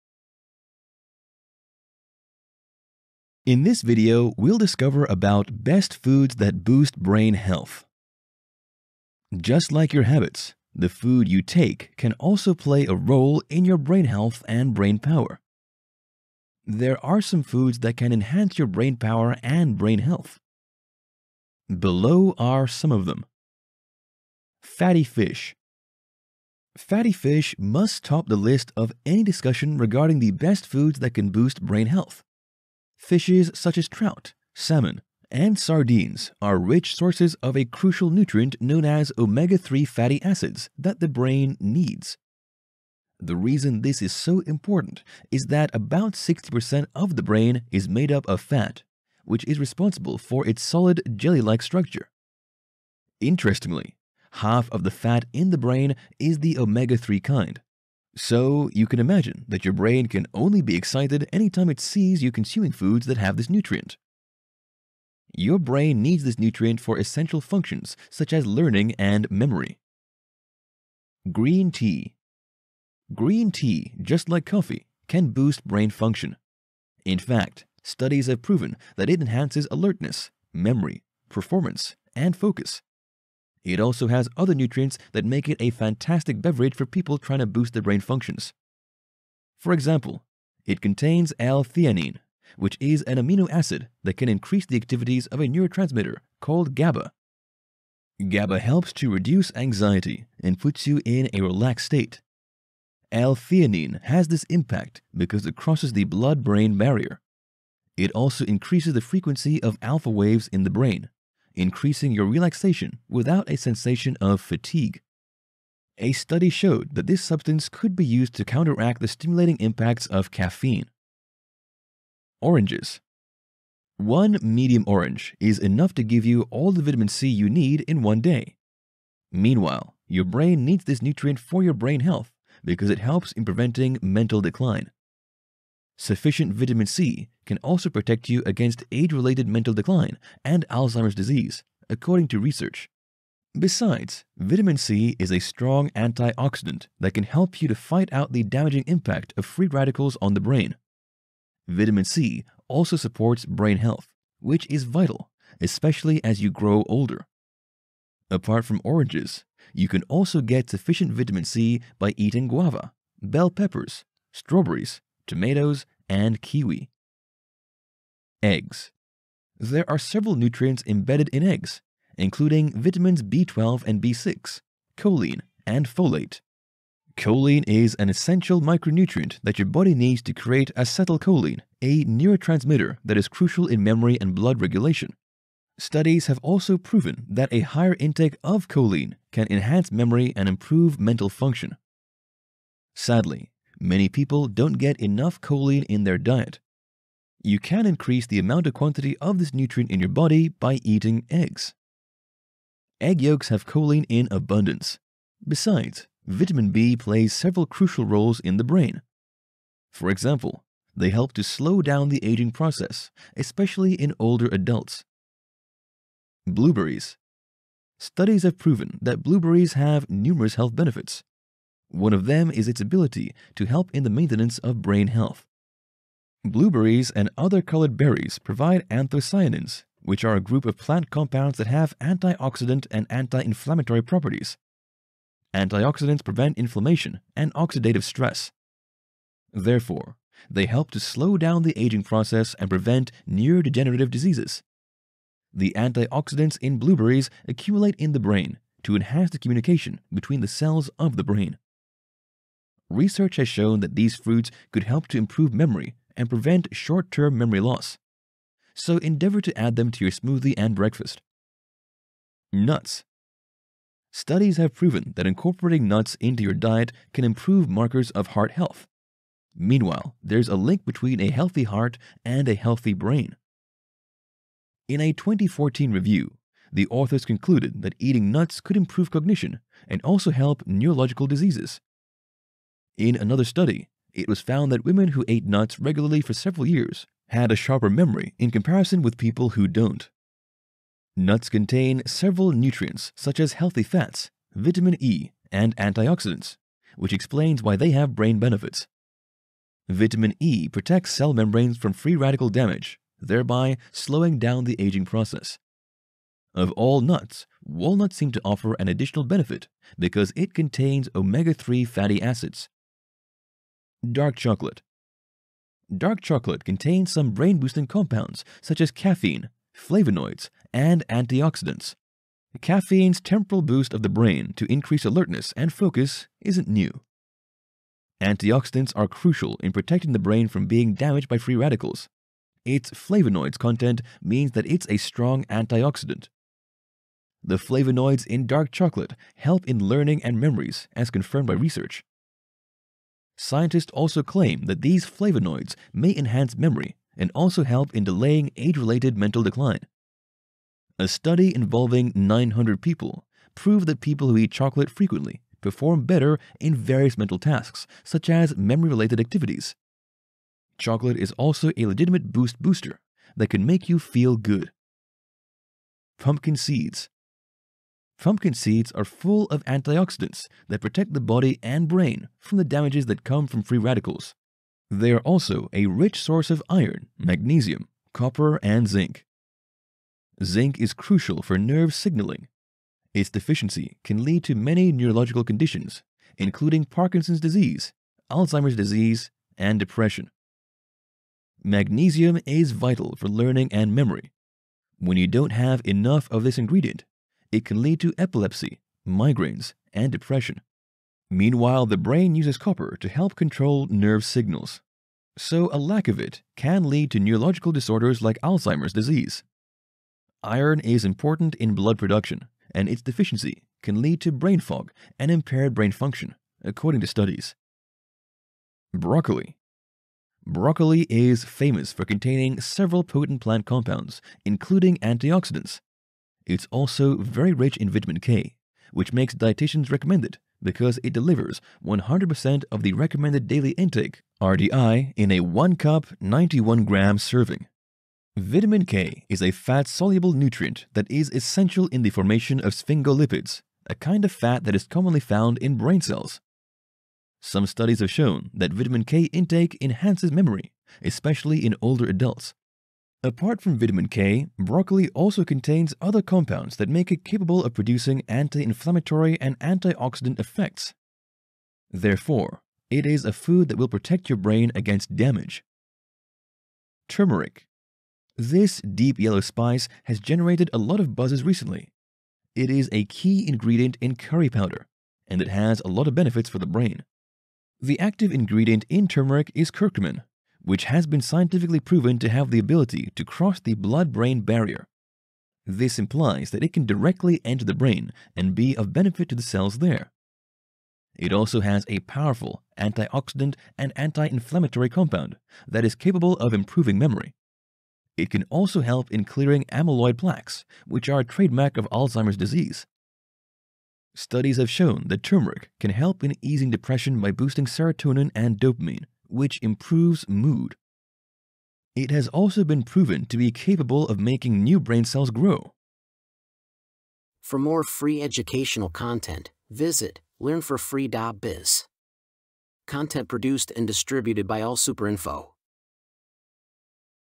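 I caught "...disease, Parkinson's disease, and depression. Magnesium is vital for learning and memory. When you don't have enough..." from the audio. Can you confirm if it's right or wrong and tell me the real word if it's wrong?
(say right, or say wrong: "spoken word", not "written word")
wrong: "Alzheimer", not "Parkinson".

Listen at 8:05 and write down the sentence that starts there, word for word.
This implies that it can directly enter the brain and be of benefit to the cells there.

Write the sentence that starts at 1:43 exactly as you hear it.
L-theanine has this impact because it crosses the blood-brain barrier.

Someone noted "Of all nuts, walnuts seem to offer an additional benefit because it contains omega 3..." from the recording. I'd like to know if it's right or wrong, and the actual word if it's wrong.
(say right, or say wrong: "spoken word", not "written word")
right.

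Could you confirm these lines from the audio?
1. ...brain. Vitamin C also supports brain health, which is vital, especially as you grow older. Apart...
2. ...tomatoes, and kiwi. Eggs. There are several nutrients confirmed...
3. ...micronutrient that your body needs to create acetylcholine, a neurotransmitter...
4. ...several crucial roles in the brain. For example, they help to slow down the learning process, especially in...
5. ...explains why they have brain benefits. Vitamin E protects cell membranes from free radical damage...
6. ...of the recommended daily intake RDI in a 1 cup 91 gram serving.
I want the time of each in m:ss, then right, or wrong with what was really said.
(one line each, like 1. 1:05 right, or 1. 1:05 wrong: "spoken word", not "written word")
1. 2:30 right
2. 2:45 wrong: "embedded", not "confirmed"
3. 2:58 right
4. 3:27 wrong: "aging", not "learning"
5. 4:57 right
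6. 7:12 right.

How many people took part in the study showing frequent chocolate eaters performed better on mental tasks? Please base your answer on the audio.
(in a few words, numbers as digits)
900.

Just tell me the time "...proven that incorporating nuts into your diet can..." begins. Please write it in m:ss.
4:24.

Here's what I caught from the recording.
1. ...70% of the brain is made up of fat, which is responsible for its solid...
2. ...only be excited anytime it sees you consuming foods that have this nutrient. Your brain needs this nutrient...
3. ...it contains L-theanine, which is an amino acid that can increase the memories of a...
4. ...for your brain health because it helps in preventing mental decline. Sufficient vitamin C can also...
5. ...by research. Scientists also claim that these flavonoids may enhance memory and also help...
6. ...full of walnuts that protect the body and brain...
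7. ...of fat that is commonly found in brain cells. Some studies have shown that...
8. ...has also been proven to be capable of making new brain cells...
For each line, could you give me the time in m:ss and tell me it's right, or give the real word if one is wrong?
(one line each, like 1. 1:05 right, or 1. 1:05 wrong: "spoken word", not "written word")
1. 0:46 wrong: "60", not "70"
2. 1:00 right
3. 1:30 wrong: "activities", not "memories"
4. 2:11 right
5. 5:41 right
6. 6:09 wrong: "antioxidants", not "walnuts"
7. 7:24 right
8. 8:32 right.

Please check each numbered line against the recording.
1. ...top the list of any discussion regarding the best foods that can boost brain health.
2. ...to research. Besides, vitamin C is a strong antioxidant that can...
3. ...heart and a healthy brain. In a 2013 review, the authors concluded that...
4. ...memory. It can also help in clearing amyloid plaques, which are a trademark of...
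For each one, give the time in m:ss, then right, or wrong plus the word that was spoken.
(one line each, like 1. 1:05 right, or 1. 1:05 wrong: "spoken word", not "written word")
1. 0:28 right
2. 2:22 right
3. 4:31 wrong: "2014", not "2013"
4. 8:16 right.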